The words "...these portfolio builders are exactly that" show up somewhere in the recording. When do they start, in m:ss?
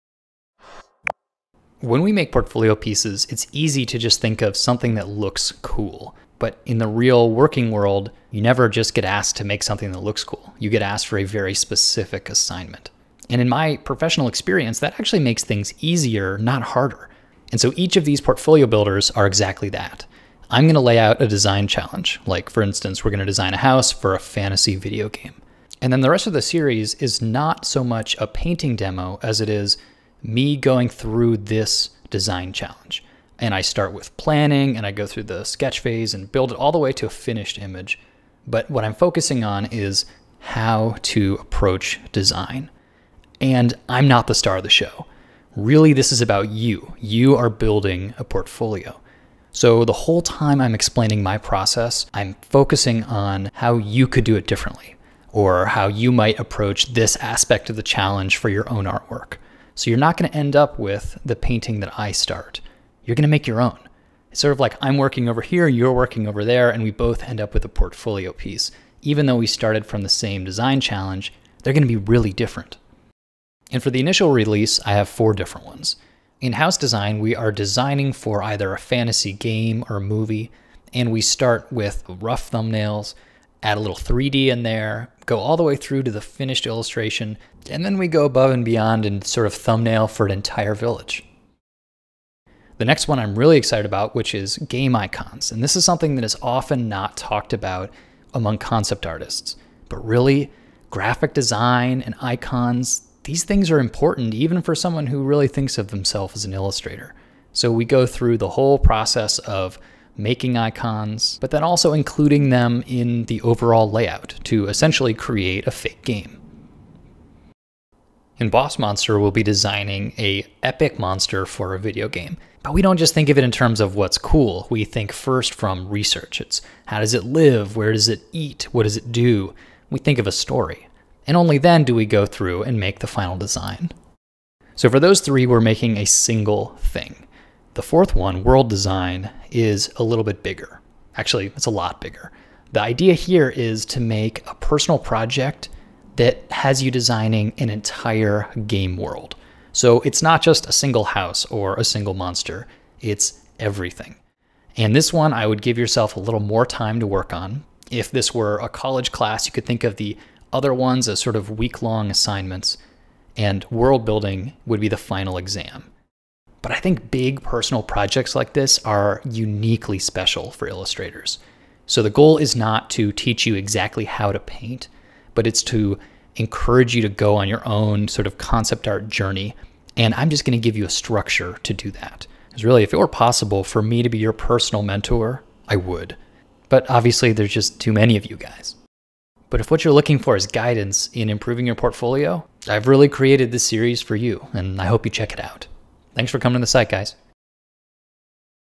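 0:18.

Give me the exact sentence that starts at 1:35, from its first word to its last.
And this is something that is often not talked about among concept artists.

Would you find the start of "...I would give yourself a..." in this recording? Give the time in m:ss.
2:35.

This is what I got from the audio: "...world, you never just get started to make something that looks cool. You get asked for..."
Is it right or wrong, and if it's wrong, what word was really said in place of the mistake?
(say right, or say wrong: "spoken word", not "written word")
wrong: "asked", not "started".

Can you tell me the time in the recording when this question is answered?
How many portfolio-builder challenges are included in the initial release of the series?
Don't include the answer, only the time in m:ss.
1:15.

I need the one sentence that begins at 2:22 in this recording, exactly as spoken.
The idea here is to make a personal project that has you designing an entire game world.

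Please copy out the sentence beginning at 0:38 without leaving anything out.
But what I'm focusing on is how to approach design.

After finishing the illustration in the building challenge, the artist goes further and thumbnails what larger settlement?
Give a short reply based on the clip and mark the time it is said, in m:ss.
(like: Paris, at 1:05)
An entire village, at 1:30.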